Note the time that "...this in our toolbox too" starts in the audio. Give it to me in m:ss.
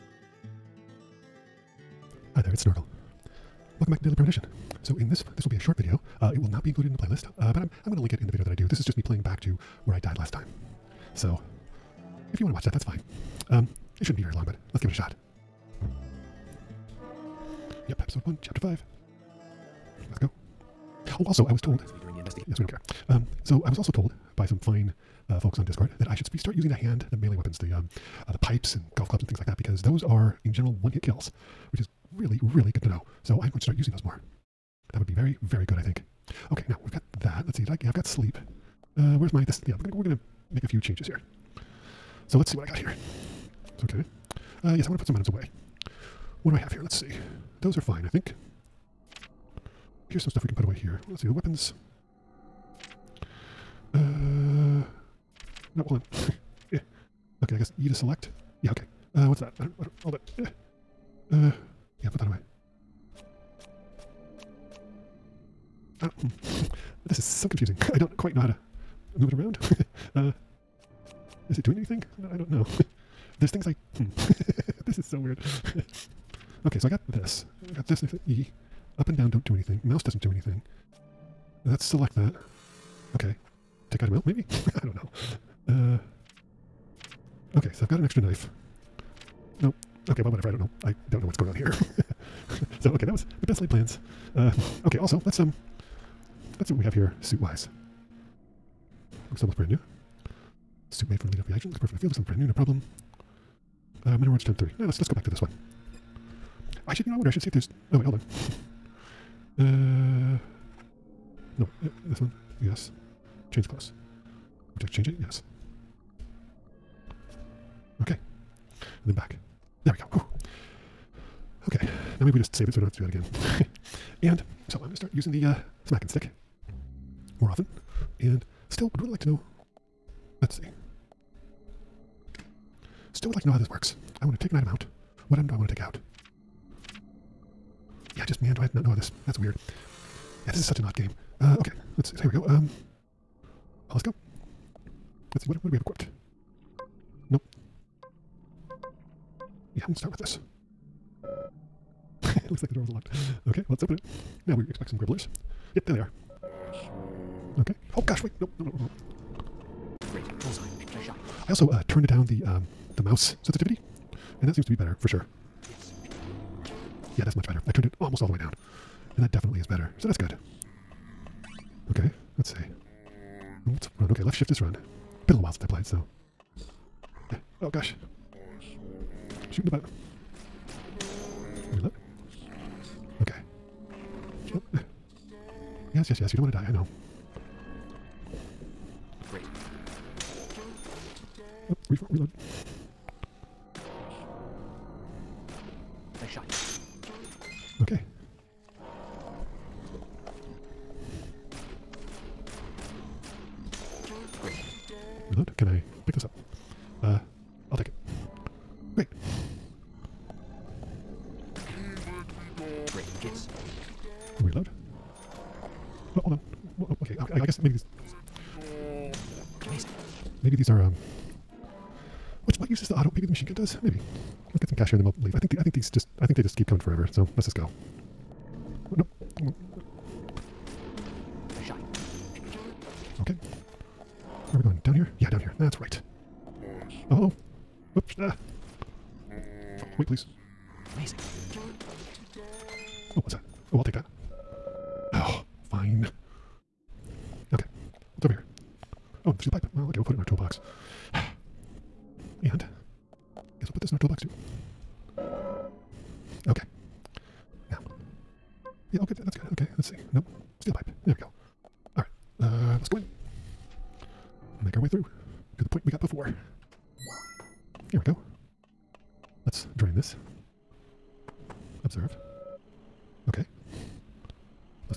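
4:13.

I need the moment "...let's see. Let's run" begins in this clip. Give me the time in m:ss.
2:52.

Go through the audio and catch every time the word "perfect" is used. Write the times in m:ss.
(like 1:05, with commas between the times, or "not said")
1:41.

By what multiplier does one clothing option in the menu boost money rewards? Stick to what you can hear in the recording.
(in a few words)
3.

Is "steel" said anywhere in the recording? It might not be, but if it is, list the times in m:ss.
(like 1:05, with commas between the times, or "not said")
4:09, 4:20.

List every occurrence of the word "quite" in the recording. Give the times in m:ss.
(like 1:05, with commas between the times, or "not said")
1:08.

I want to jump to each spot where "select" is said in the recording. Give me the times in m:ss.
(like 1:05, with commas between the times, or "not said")
0:57, 1:21.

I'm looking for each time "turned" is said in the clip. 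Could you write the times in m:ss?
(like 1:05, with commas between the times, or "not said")
2:41, 2:47.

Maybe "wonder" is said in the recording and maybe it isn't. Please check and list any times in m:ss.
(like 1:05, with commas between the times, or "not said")
1:47.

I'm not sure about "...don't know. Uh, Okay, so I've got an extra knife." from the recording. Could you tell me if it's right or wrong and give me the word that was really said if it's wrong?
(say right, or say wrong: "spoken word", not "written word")
right.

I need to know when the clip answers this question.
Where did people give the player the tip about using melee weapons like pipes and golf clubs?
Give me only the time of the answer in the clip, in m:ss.
0:25.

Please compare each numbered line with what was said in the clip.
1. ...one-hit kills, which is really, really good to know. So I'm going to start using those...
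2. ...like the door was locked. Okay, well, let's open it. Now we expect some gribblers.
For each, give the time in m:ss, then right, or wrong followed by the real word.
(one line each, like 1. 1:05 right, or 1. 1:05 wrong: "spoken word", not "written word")
1. 0:30 right
2. 2:32 right.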